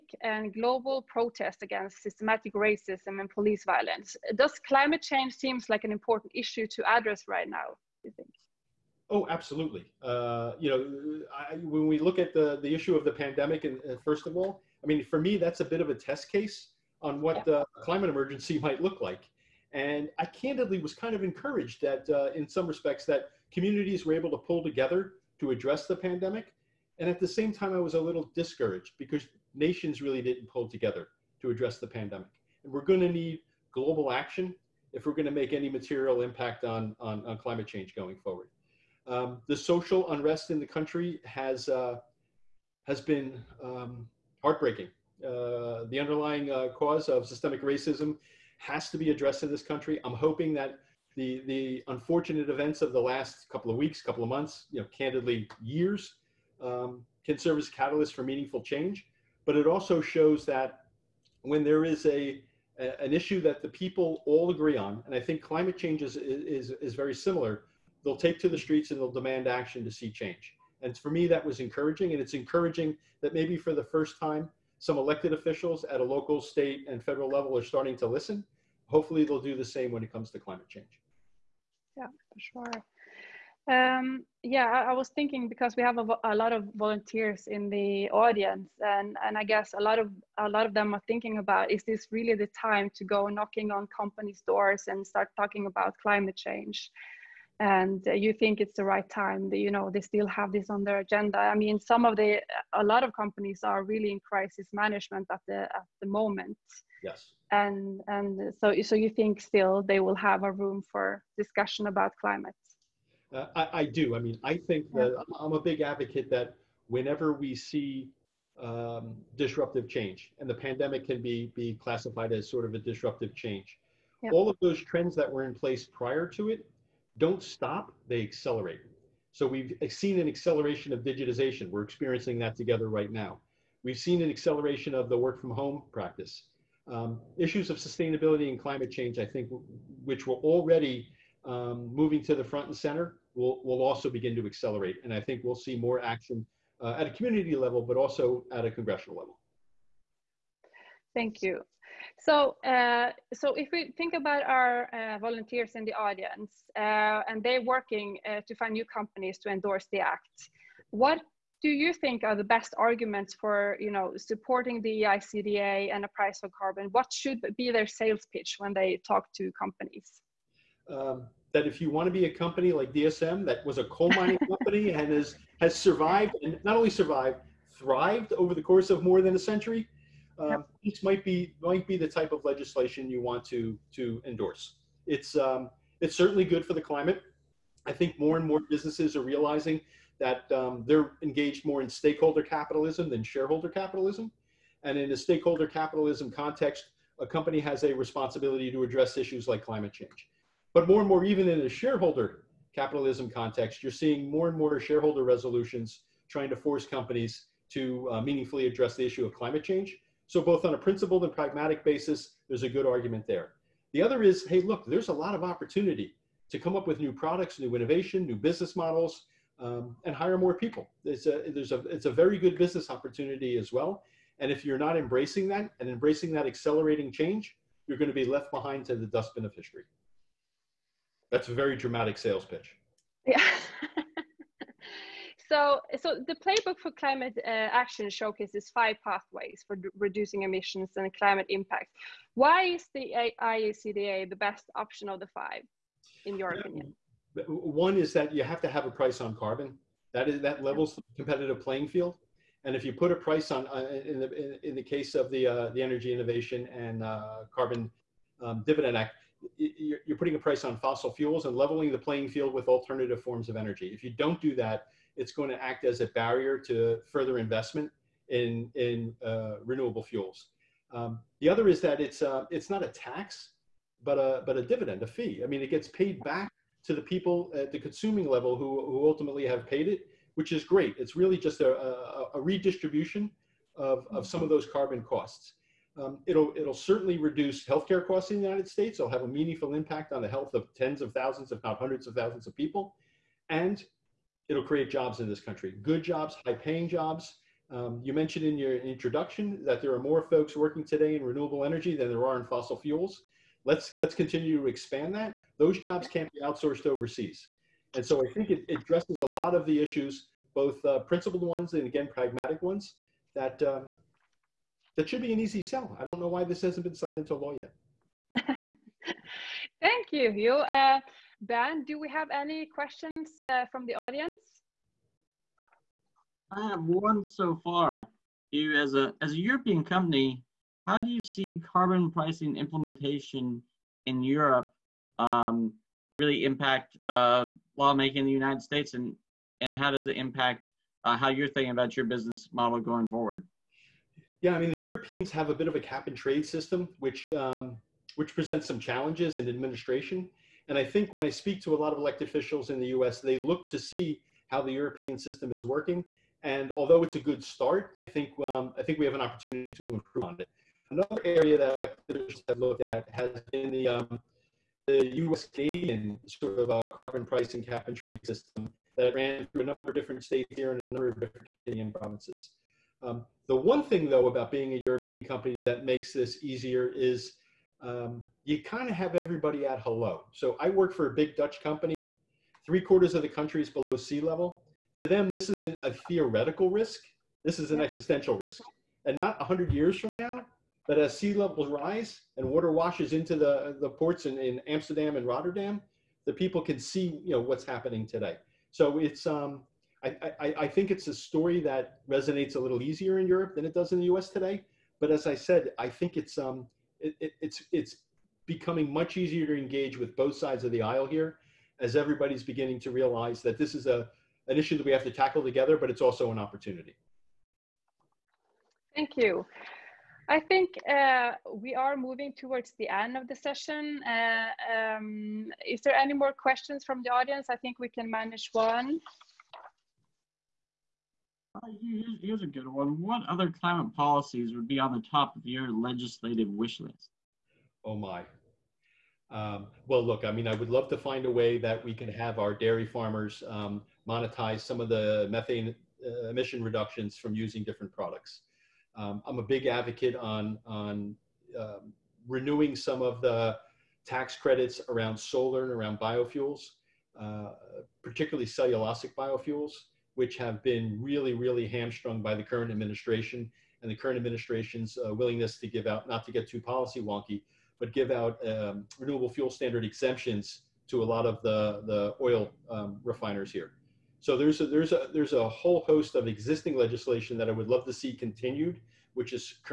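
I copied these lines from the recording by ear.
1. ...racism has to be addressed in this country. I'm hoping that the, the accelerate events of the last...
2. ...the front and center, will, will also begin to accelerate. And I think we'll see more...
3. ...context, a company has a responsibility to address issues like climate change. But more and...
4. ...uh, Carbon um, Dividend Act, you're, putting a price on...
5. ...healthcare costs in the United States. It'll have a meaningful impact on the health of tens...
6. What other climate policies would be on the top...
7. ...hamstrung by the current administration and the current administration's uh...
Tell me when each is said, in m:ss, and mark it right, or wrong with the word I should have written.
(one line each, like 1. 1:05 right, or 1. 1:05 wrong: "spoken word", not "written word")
1. 0:47 wrong: "unfortunate", not "accelerate"
2. 2:22 right
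3. 3:16 right
4. 4:17 right
5. 4:47 right
6. 7:13 right
7. 7:41 right.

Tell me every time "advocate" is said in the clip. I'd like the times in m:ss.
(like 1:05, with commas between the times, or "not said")
1:55, 7:29.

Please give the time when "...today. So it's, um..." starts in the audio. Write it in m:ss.
6:38.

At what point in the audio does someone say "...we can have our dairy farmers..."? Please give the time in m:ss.
7:21.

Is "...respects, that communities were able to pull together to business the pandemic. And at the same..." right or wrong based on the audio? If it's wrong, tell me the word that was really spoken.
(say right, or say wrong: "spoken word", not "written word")
wrong: "address", not "business".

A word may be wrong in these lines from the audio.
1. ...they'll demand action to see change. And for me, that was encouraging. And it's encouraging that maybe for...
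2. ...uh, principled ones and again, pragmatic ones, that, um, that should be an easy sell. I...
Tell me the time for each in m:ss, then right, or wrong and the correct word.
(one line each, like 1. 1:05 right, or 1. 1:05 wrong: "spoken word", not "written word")
1. 1:08 right
2. 5:10 right.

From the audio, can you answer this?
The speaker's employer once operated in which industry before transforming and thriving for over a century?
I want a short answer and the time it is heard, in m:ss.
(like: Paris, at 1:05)
coal mining, at 2:53.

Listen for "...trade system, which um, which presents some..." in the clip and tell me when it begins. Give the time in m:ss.
5:46.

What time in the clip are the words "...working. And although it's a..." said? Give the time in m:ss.
5:55.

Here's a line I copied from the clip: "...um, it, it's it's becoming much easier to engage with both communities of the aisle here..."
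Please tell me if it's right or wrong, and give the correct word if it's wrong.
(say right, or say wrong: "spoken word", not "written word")
wrong: "sides", not "communities".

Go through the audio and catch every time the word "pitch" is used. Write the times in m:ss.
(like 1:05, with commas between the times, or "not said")
2:48, 3:52.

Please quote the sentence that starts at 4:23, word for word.
If you don't do that, it's going to act as a barrier to further investment in, in uh, renewable fuels.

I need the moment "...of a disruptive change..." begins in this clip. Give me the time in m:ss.
2:02.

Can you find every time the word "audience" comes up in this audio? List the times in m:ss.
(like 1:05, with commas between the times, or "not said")
1:28, 2:35, 5:23, 7:07.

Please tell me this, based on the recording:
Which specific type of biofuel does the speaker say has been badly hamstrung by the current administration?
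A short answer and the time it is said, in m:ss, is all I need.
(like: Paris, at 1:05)
cellulosic biofuels, at 7:38.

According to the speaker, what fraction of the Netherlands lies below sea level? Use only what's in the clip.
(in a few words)
three quarters.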